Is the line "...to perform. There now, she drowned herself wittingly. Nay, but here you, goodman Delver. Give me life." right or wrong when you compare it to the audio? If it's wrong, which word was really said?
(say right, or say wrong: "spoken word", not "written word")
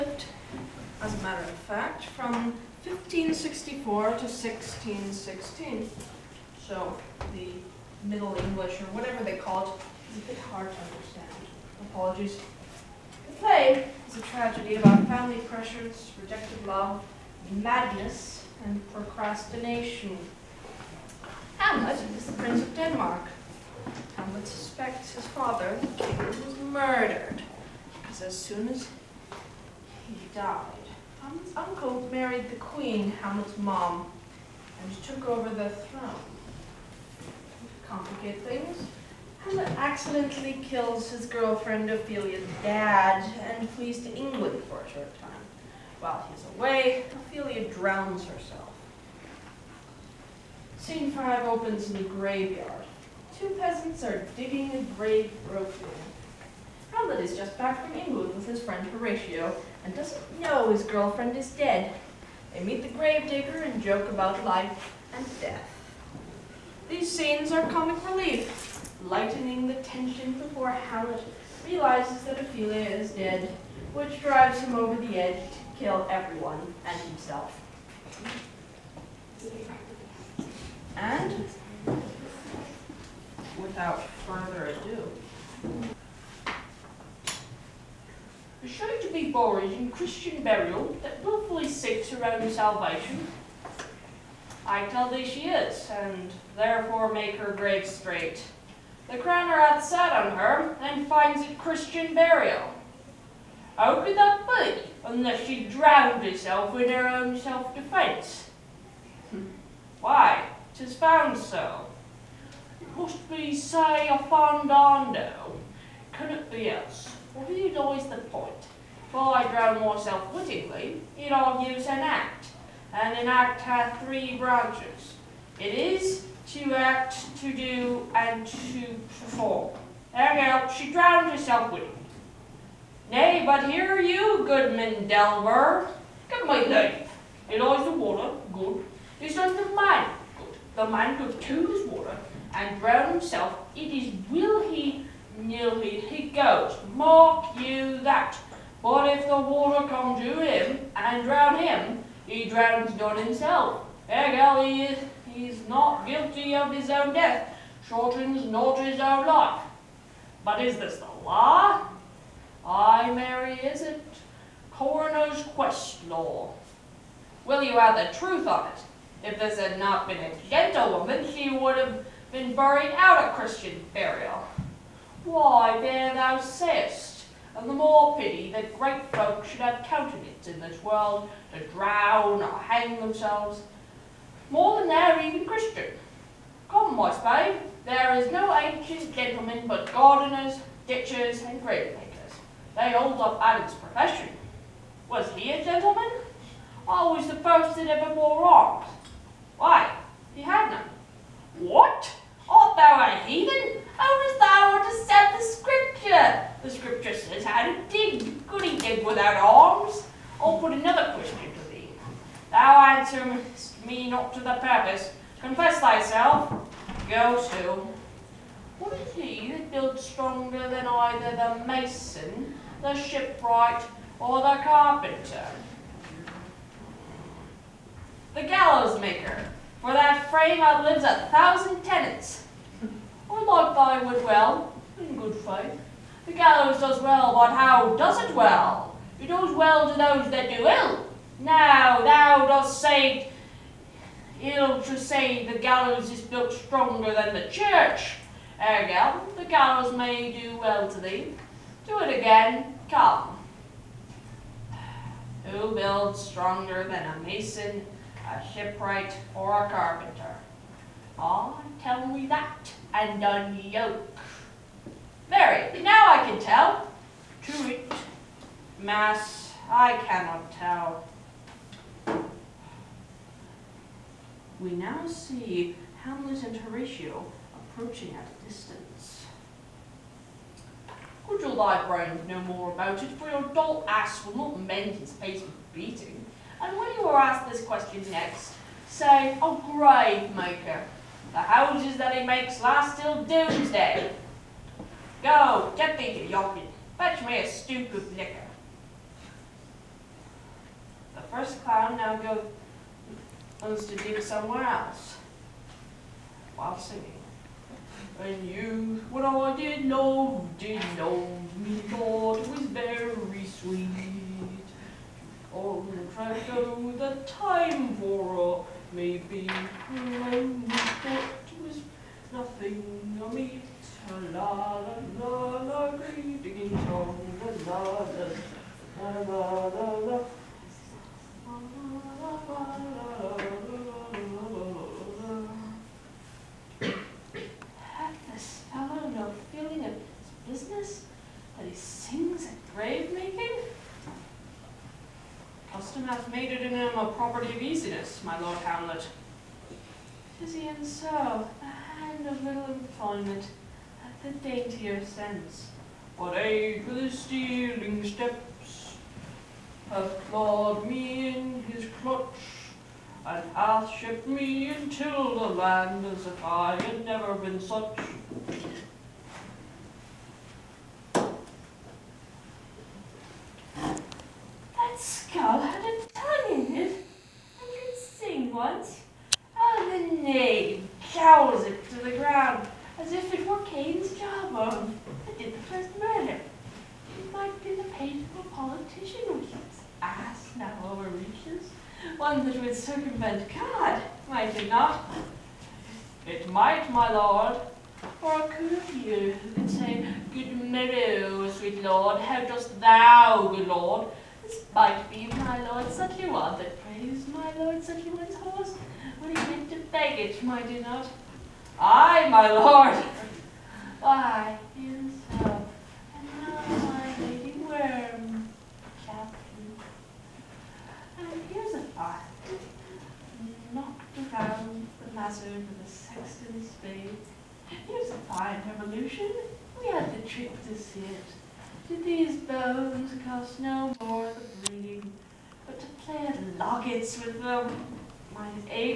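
right.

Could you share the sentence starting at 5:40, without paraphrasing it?
business that he sings at grave making?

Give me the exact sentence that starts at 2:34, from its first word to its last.
Hegel, he is is not guilty of his own death, shortens not his own life.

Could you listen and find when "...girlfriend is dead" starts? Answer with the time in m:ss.
1:00.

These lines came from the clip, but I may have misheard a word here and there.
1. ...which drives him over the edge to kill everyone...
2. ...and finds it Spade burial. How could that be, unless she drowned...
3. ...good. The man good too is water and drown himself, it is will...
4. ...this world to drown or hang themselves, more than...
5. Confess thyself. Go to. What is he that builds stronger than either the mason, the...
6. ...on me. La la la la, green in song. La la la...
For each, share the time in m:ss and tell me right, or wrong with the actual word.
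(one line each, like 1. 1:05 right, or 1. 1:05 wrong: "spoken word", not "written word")
1. 1:13 right
2. 1:40 wrong: "Christian", not "Spade"
3. 2:20 wrong: "brown", not "drown"
4. 3:00 right
5. 3:35 right
6. 5:23 right.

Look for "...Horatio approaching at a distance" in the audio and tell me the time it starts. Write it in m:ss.
4:36.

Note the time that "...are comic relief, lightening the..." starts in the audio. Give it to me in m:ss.
1:07.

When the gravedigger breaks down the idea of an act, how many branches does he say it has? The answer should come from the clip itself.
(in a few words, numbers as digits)
3.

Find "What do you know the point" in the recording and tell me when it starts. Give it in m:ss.
1:57.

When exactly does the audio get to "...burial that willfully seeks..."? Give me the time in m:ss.
1:30.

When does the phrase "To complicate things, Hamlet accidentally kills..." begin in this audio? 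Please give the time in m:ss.
0:37.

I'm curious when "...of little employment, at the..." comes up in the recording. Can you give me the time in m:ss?
5:52.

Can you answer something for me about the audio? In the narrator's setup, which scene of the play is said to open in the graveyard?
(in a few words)
Scene 5.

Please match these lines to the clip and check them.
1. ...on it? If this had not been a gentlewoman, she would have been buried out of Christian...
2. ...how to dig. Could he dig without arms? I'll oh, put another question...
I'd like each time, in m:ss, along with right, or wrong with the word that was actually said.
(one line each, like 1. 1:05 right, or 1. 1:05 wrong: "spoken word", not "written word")
1. 2:48 right
2. 3:27 right.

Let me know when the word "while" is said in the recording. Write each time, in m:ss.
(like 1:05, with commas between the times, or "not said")
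0:45, 5:06.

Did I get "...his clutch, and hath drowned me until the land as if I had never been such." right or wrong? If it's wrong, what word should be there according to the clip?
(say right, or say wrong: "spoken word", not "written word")
wrong: "shipped", not "drowned".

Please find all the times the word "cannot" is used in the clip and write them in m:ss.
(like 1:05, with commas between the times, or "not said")
1:56, 4:29.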